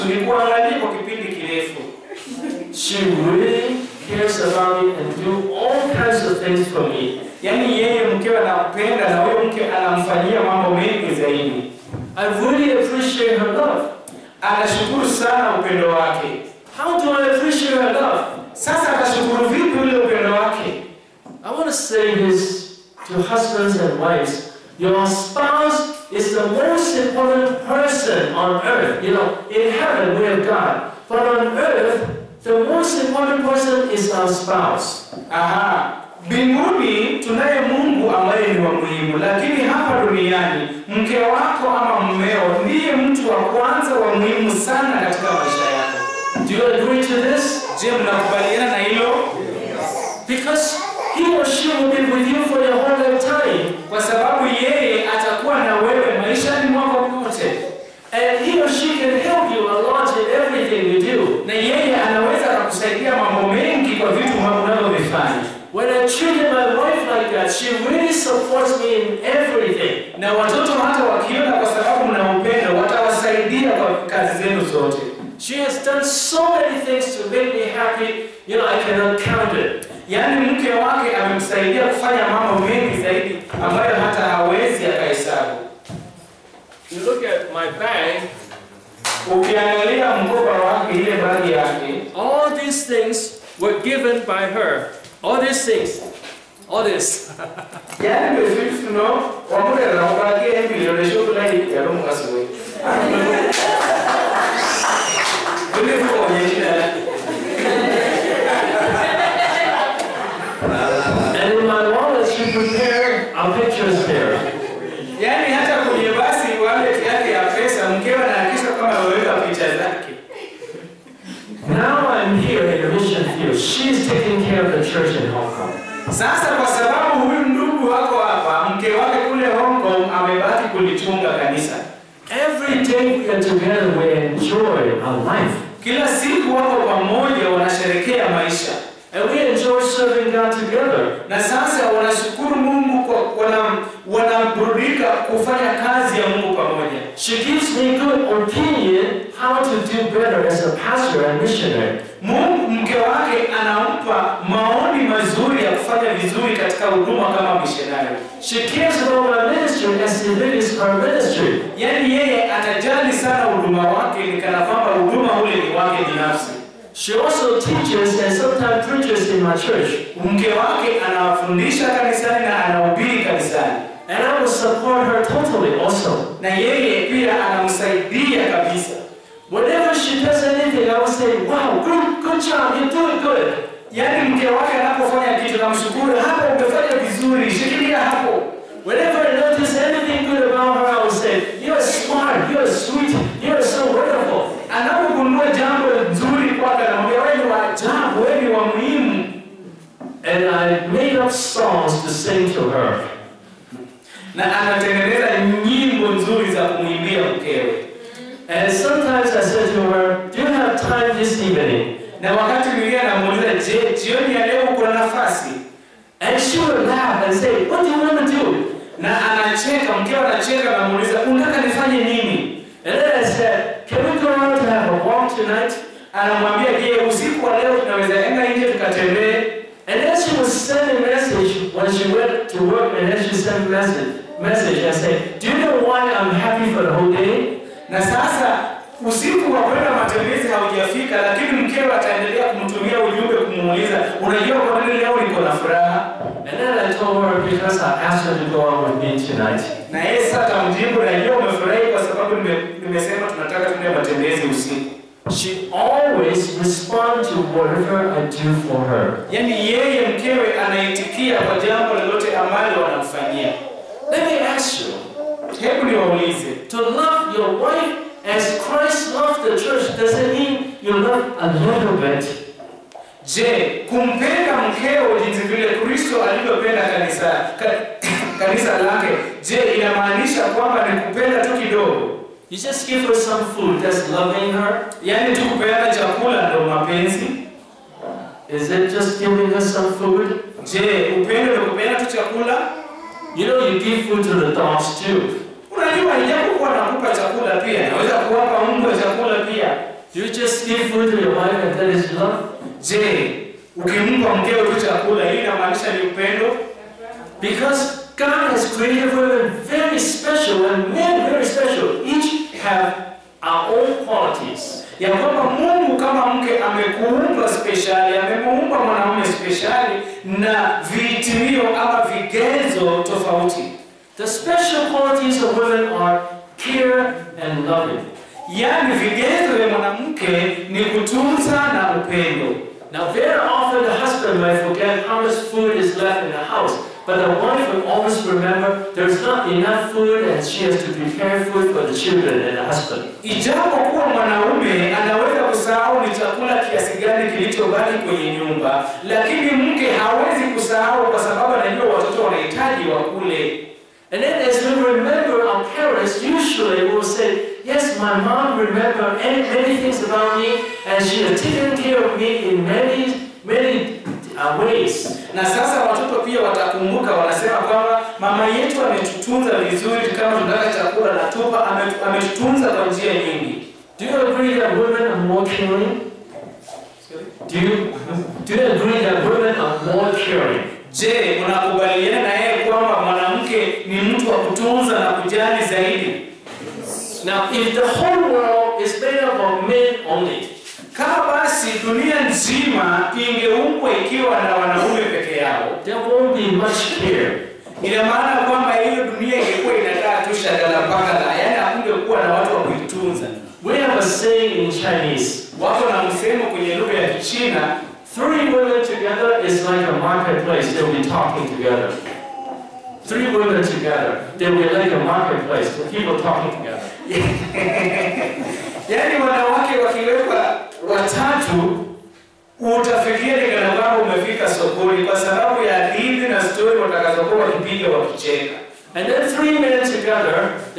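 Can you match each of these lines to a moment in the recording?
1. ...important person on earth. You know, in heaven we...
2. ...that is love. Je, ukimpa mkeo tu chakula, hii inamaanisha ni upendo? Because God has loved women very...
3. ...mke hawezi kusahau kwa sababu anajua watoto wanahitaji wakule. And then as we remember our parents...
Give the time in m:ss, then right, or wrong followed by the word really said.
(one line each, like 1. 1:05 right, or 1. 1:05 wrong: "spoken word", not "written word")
1. 0:26 right
2. 5:01 wrong: "created", not "loved"
3. 5:49 right.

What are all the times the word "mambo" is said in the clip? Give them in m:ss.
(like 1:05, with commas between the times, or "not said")
0:10, 1:22.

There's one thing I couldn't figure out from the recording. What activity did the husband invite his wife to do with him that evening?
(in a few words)
have a walk.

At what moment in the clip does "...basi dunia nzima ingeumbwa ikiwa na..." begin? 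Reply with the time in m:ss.
6:31.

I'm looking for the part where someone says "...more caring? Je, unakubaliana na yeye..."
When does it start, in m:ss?
6:19.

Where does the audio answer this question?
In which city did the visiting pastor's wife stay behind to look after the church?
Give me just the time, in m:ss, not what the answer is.
2:09.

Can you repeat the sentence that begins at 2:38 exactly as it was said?
She cares about our ministry as it is her ministry.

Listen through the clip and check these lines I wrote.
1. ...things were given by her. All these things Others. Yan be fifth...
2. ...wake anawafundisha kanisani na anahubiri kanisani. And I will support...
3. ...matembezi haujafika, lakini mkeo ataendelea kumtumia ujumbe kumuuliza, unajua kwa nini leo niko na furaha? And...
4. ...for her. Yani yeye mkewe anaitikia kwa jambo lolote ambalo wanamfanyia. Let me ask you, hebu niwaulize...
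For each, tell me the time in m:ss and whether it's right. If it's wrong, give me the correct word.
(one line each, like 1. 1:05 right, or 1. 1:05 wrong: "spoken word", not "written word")
1. 1:32 right
2. 2:50 right
3. 3:59 right
4. 4:18 right.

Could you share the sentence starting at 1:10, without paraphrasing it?
Na watoto hata wakiona kwa sababu mna upendo watawasaidia kwa kazi zenu zote.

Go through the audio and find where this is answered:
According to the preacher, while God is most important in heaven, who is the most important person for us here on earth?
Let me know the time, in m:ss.
0:34.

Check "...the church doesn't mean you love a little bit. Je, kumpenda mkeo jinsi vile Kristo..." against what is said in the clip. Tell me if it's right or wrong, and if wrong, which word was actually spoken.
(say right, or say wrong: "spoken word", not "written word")
right.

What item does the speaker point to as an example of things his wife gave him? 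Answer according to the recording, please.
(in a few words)
my bag.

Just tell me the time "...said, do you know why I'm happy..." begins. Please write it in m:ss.
3:54.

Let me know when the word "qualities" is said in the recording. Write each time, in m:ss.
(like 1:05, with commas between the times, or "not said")
5:14, 5:24.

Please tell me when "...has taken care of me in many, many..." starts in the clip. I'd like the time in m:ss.
6:01.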